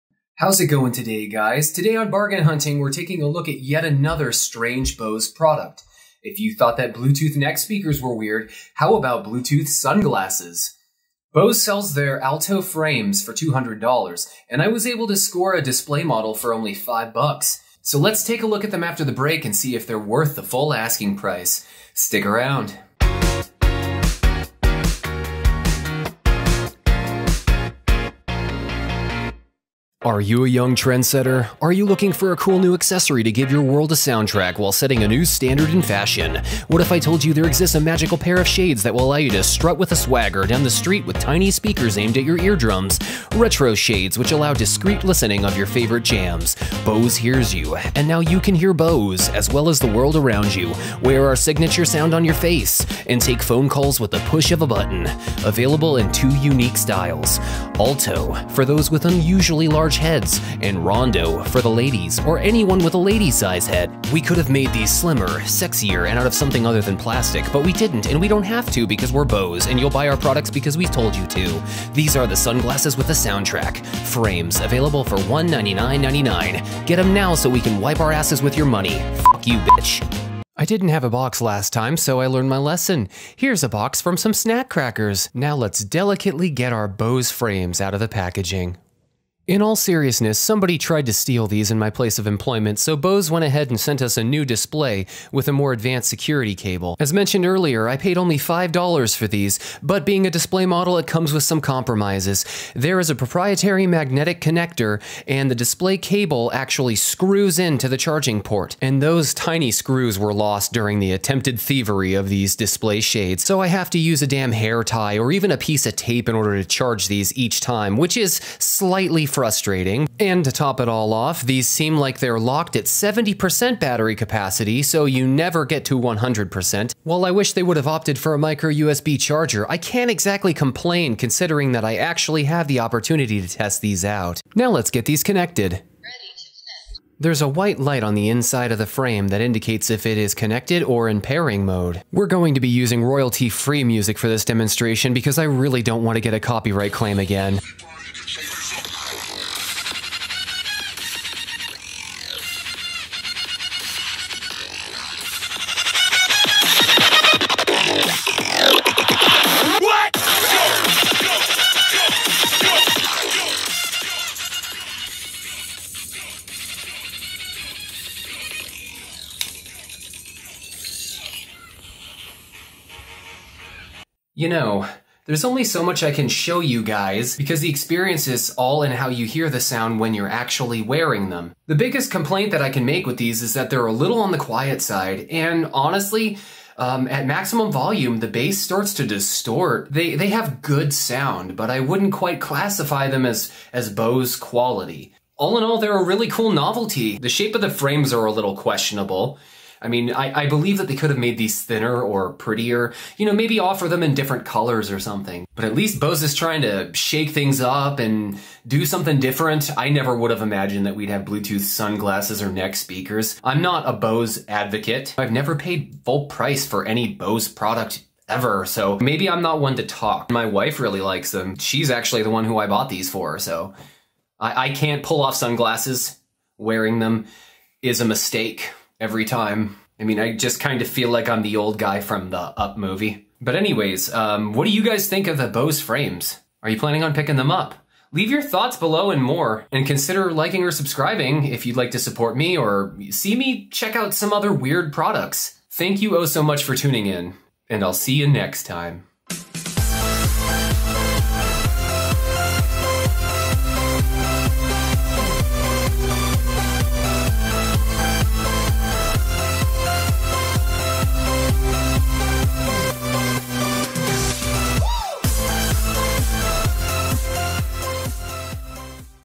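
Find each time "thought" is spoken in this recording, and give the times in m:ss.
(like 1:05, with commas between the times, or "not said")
0:06, 3:58.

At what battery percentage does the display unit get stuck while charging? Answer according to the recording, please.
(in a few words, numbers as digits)
70%.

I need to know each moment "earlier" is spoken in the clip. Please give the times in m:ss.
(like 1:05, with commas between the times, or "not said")
1:37.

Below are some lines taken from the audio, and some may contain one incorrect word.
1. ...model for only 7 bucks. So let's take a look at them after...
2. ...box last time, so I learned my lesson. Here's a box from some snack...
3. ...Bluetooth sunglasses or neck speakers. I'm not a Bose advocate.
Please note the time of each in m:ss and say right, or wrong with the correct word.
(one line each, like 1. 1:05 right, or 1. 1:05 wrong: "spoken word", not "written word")
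1. 0:16 wrong: "5", not "7"
2. 1:21 right
3. 3:31 right.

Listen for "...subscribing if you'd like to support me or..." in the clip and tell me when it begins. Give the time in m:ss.
4:00.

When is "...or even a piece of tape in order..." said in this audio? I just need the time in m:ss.
1:55.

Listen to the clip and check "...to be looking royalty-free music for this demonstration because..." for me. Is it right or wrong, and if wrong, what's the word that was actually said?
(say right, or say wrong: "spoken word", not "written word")
wrong: "using", not "looking".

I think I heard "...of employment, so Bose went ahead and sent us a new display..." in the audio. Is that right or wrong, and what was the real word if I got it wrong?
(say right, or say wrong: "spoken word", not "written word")
right.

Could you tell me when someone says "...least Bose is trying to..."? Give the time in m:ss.
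3:25.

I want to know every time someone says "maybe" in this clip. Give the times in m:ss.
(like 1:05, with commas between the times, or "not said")
3:23, 3:39.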